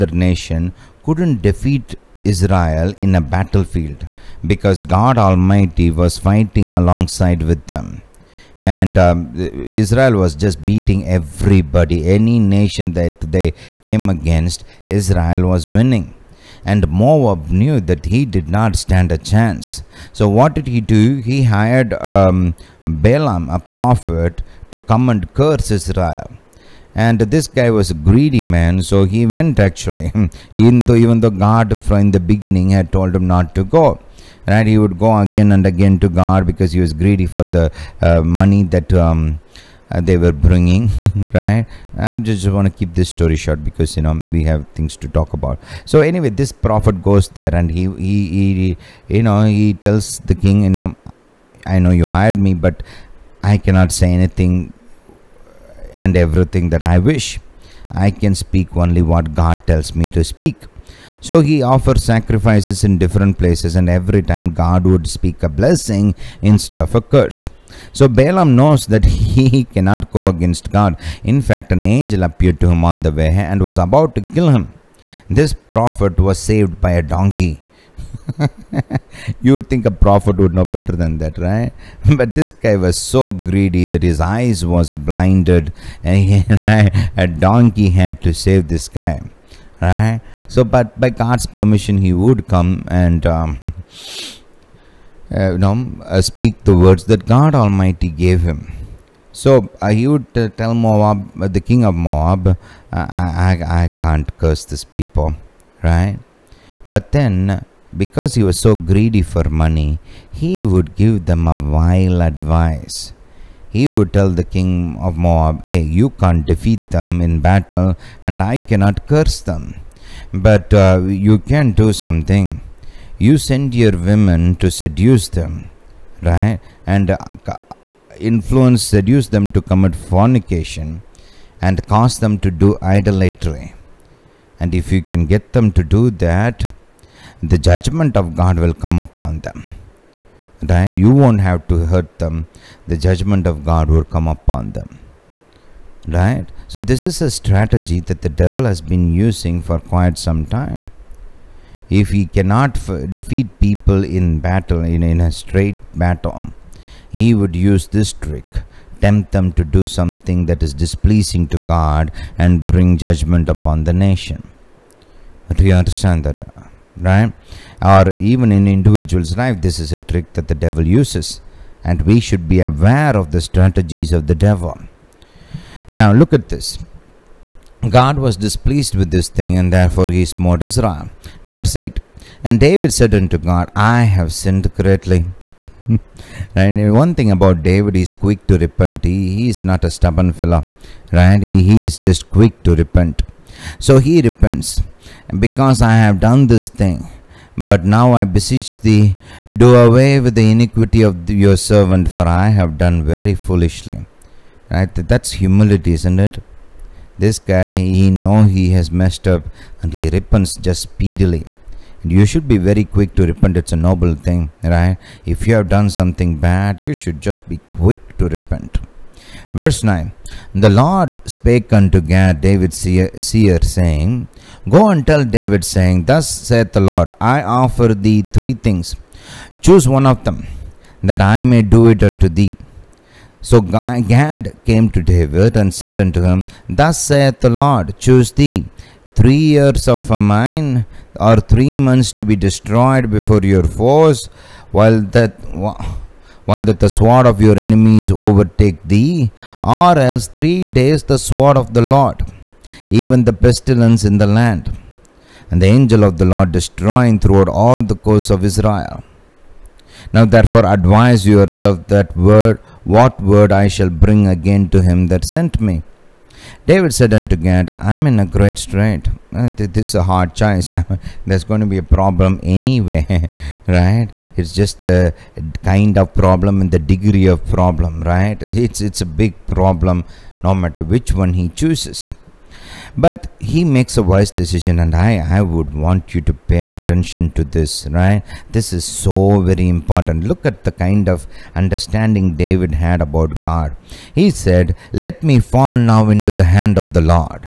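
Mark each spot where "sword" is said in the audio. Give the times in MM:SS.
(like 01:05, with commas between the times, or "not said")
04:06, 04:11.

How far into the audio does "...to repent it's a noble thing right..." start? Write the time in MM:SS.
03:33.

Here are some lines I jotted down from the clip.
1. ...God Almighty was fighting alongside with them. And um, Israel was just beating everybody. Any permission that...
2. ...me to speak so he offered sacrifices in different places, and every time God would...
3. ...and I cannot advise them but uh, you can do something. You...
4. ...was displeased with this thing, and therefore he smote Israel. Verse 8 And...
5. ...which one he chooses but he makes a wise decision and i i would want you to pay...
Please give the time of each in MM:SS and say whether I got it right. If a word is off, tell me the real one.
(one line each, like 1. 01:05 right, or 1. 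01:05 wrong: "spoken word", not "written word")
1. 00:04 wrong: "nation", not "permission"
2. 00:59 right
3. 01:58 wrong: "curse", not "advise"
4. 02:58 right
5. 04:40 right.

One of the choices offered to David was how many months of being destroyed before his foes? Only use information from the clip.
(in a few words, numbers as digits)
3 months.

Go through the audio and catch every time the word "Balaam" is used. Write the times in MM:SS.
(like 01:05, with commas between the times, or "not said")
00:22, 01:08.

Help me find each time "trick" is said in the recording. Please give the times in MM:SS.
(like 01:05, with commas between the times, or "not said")
02:38, 02:49.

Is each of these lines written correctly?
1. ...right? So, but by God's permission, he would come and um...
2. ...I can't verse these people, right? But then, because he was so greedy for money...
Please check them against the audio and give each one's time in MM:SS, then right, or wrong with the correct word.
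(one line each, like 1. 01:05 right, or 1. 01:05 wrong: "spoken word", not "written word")
1. 01:29 right
2. 01:43 wrong: "curse", not "verse".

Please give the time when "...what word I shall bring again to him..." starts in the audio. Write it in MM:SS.
04:22.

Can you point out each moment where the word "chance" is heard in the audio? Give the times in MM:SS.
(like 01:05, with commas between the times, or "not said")
00:19.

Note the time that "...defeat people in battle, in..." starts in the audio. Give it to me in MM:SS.
02:33.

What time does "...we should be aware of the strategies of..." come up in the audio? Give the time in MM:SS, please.
02:52.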